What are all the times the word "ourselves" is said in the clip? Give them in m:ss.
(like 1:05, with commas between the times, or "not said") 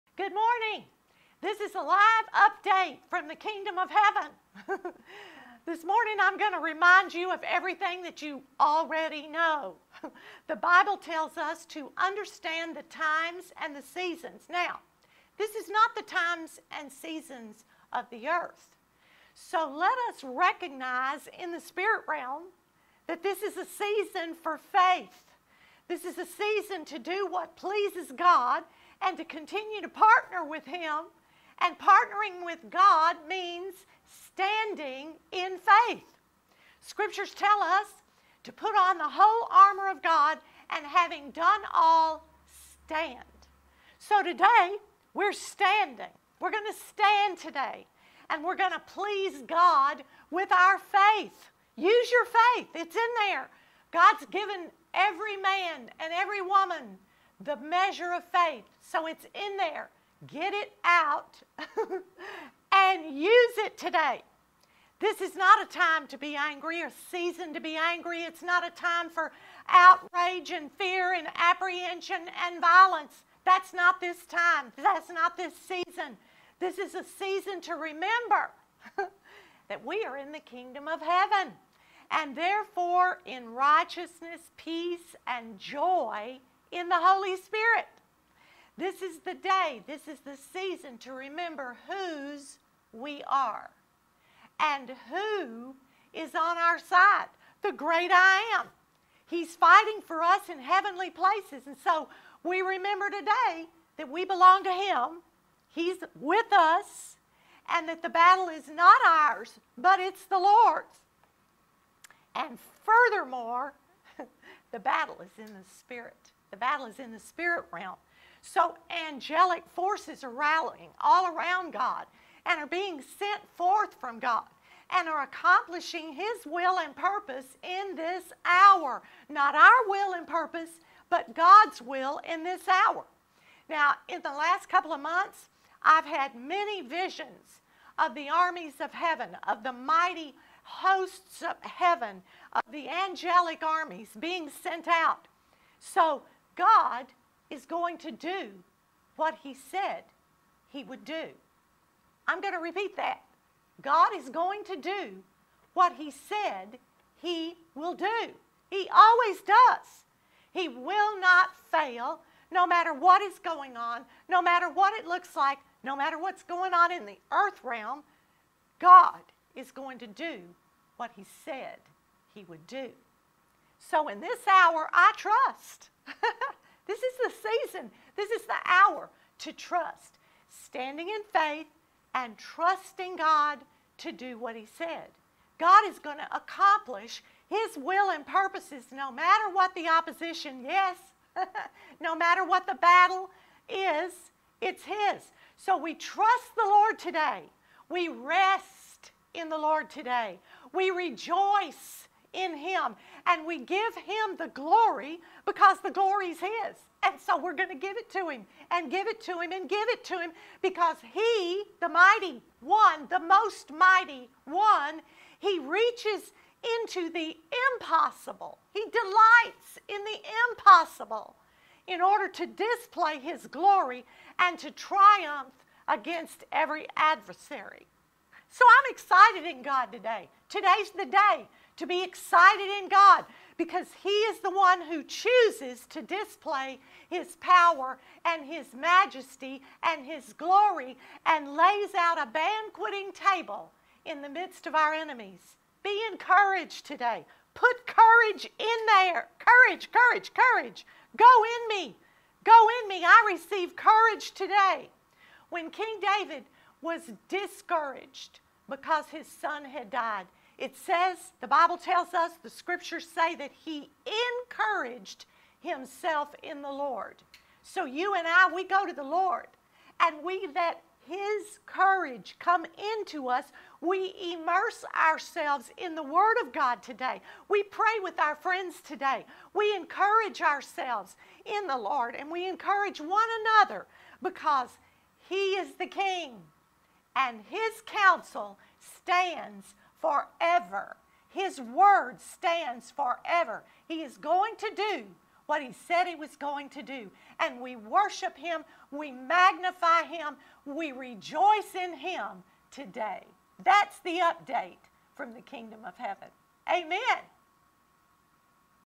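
4:34, 4:40.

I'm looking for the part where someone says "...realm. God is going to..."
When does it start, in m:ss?
2:47.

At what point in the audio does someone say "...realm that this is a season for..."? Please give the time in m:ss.
0:22.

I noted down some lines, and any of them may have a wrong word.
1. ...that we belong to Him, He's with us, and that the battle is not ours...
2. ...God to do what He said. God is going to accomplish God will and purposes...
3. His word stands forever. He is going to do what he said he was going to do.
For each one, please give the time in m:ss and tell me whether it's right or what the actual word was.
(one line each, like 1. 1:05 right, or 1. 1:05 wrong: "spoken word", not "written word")
1. 1:43 right
2. 3:03 wrong: "His", not "God"
3. 4:51 right.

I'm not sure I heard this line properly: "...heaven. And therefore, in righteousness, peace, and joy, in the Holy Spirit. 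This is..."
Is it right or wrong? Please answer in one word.
right.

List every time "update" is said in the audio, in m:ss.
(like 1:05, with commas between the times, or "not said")
0:02, 5:04.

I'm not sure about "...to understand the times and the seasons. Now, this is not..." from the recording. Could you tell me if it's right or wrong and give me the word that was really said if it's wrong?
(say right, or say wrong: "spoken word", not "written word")
right.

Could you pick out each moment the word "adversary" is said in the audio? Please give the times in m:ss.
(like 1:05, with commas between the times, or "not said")
3:46.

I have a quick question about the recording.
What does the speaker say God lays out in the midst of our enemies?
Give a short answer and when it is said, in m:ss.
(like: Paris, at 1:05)
A banqueting table, at 4:02.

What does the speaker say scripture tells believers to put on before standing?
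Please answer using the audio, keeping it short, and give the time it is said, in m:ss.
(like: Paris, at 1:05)
The whole armor of God, at 0:39.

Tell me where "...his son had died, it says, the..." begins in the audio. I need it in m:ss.
4:19.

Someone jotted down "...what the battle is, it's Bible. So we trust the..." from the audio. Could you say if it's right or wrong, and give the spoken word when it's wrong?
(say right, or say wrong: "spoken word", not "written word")
wrong: "His", not "Bible".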